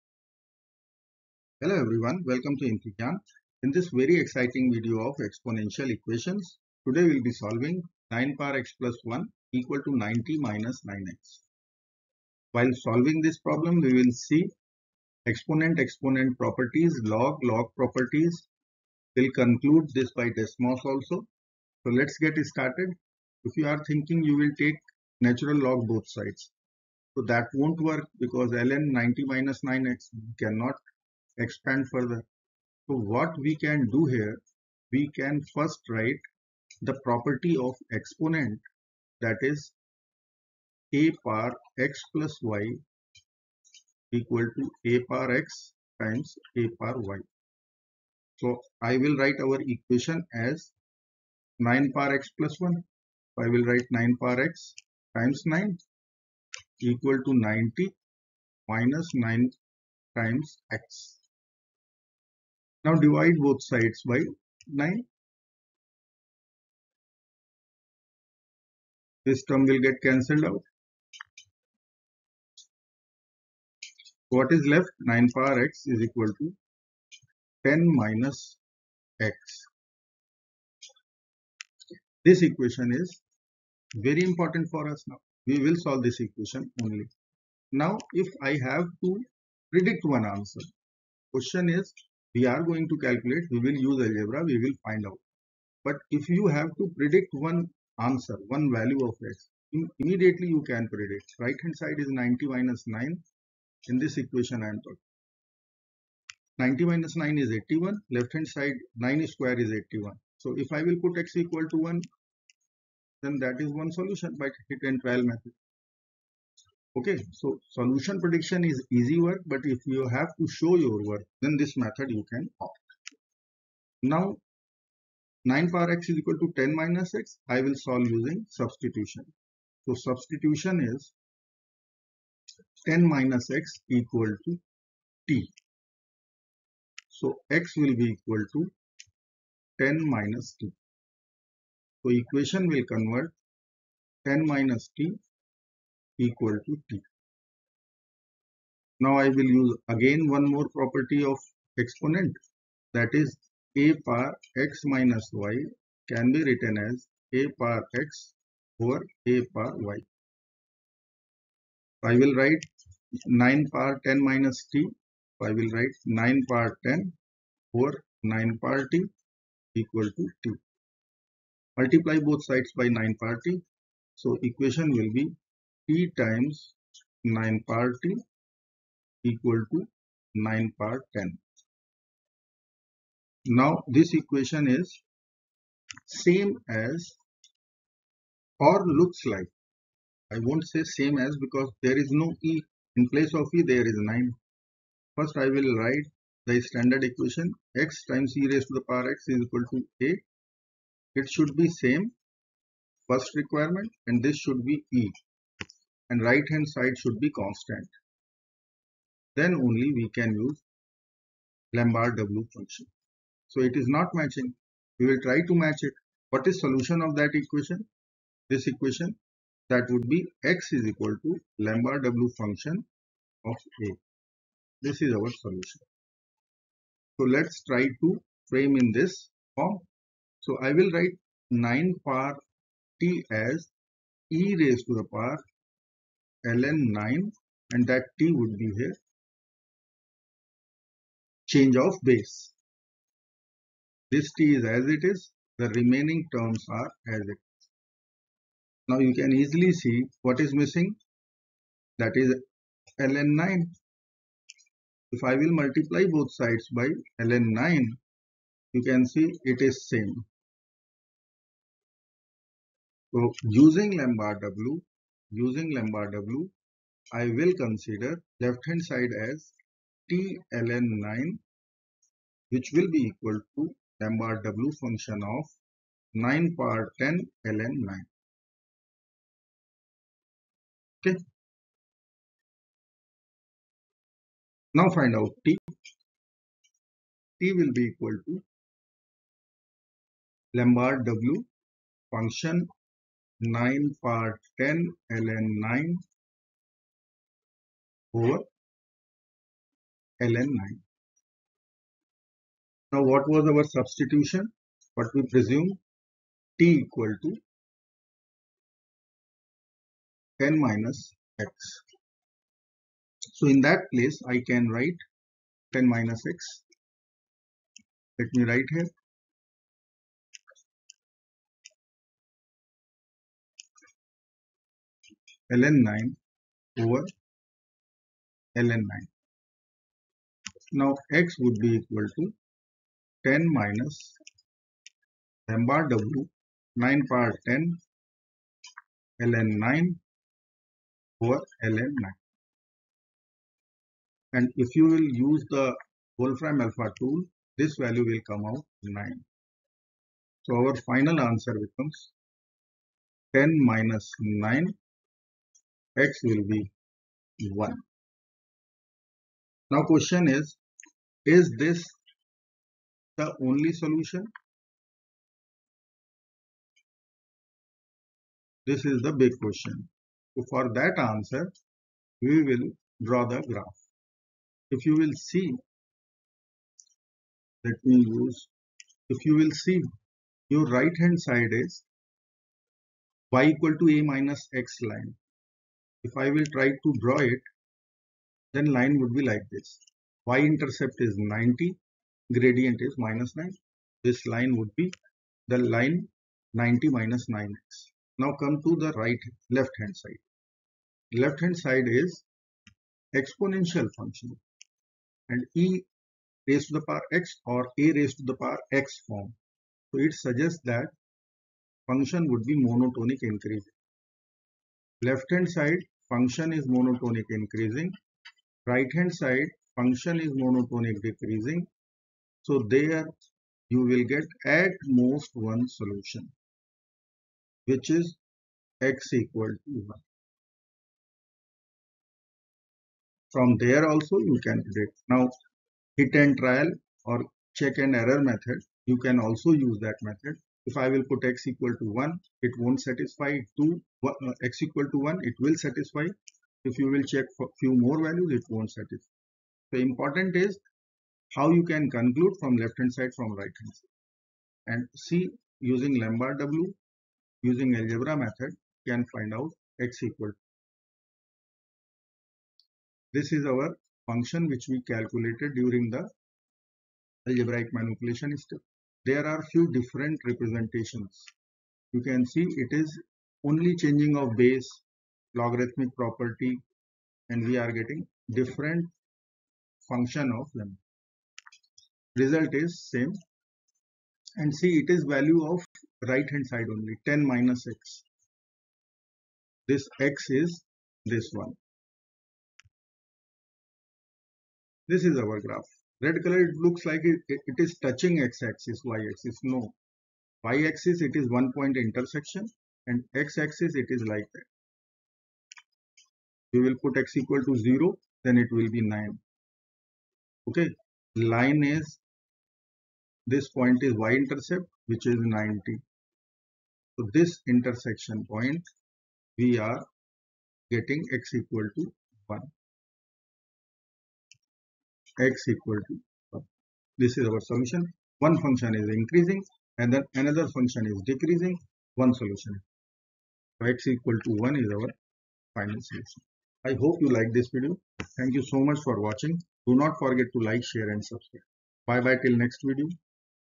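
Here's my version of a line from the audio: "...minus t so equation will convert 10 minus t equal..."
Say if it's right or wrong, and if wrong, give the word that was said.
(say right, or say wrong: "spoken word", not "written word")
right.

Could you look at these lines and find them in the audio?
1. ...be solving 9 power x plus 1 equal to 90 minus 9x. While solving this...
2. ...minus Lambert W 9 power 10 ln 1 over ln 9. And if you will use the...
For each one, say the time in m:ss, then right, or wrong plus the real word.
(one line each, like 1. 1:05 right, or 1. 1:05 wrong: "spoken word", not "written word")
1. 0:07 right
2. 5:33 wrong: "9", not "1".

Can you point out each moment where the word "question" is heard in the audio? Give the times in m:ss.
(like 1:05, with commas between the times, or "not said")
1:31, 5:59, 6:09.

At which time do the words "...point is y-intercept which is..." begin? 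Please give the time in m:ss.
8:33.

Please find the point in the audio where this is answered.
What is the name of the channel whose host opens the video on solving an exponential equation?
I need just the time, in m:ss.
0:02.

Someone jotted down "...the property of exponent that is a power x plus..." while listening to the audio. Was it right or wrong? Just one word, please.
right.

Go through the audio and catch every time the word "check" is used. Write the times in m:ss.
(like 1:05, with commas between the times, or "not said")
7:17, 7:27.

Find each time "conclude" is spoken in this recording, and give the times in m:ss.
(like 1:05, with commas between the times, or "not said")
0:19, 7:31.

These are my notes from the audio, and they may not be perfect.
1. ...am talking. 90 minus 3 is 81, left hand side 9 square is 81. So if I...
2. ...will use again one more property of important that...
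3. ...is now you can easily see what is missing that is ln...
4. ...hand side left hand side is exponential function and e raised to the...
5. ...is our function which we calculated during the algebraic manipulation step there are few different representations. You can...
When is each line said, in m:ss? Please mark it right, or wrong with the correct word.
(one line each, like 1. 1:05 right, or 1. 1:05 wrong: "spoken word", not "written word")
1. 1:44 wrong: "9", not "3"
2. 2:29 wrong: "exponent", not "important"
3. 4:07 right
4. 6:39 right
5. 7:43 right.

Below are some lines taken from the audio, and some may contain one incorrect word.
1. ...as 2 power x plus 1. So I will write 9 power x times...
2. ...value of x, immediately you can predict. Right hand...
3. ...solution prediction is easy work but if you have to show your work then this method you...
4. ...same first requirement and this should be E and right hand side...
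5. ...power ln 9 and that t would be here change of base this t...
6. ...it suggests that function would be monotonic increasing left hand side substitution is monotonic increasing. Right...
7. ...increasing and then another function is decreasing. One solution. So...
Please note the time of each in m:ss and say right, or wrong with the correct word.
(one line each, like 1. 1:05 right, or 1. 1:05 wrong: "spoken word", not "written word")
1. 0:50 wrong: "9", not "2"
2. 1:38 right
3. 1:57 right
4. 3:21 right
5. 3:55 right
6. 6:50 wrong: "function", not "substitution"
7. 8:48 right.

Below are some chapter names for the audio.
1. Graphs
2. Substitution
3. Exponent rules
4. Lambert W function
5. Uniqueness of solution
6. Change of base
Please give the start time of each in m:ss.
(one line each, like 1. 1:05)
1. 8:21
2. 2:11
3. 0:43
4. 3:16
5. 6:11
6. 4:02.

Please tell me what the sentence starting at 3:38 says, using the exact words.
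This equation that would be x is equal to Lambert W function of A.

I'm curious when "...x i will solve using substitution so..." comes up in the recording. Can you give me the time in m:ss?
2:07.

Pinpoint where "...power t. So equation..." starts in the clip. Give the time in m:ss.
2:53.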